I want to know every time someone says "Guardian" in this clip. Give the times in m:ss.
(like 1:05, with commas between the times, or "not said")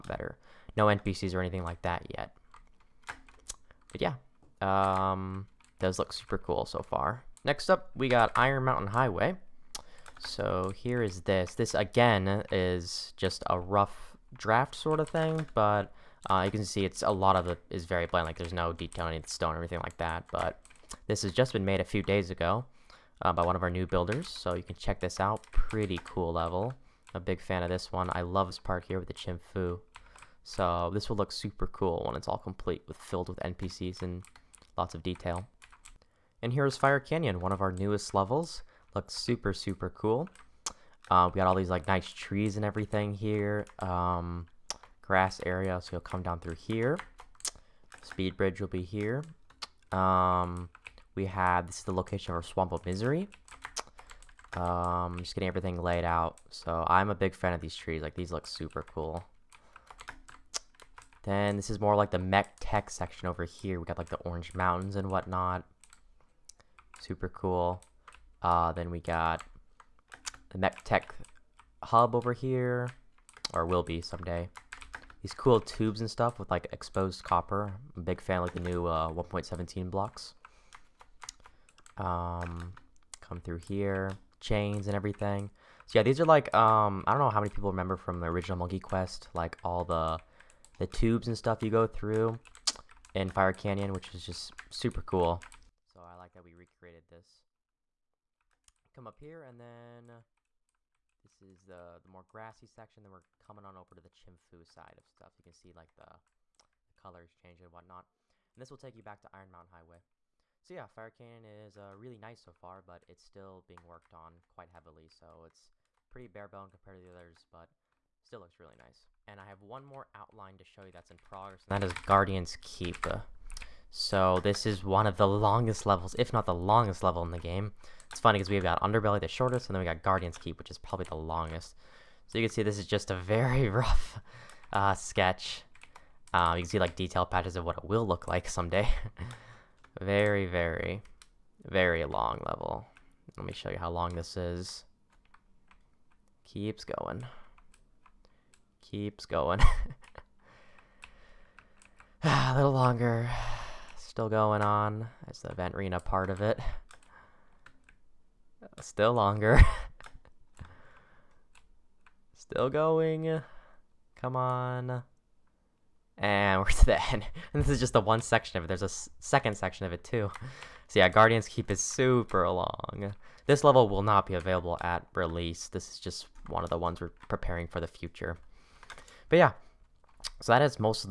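2:02, 2:10, 2:51.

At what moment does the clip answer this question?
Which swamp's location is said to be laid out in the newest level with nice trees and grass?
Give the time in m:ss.
0:52.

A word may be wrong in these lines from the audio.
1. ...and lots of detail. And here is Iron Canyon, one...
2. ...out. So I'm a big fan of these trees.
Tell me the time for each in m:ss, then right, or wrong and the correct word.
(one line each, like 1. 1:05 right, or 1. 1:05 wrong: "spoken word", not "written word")
1. 0:34 wrong: "Fire", not "Iron"
2. 0:56 right.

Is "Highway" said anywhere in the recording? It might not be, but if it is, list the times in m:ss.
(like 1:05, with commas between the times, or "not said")
0:08, 1:49.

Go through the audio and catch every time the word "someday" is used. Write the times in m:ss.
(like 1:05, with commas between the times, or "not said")
1:14, 2:18.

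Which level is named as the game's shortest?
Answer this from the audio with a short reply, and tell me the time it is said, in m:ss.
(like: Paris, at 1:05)
Underbelly, at 2:08.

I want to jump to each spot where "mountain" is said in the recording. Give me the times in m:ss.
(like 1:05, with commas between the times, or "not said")
0:08, 1:04, 1:49.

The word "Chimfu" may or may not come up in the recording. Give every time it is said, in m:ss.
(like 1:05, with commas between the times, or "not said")
0:29, 1:44.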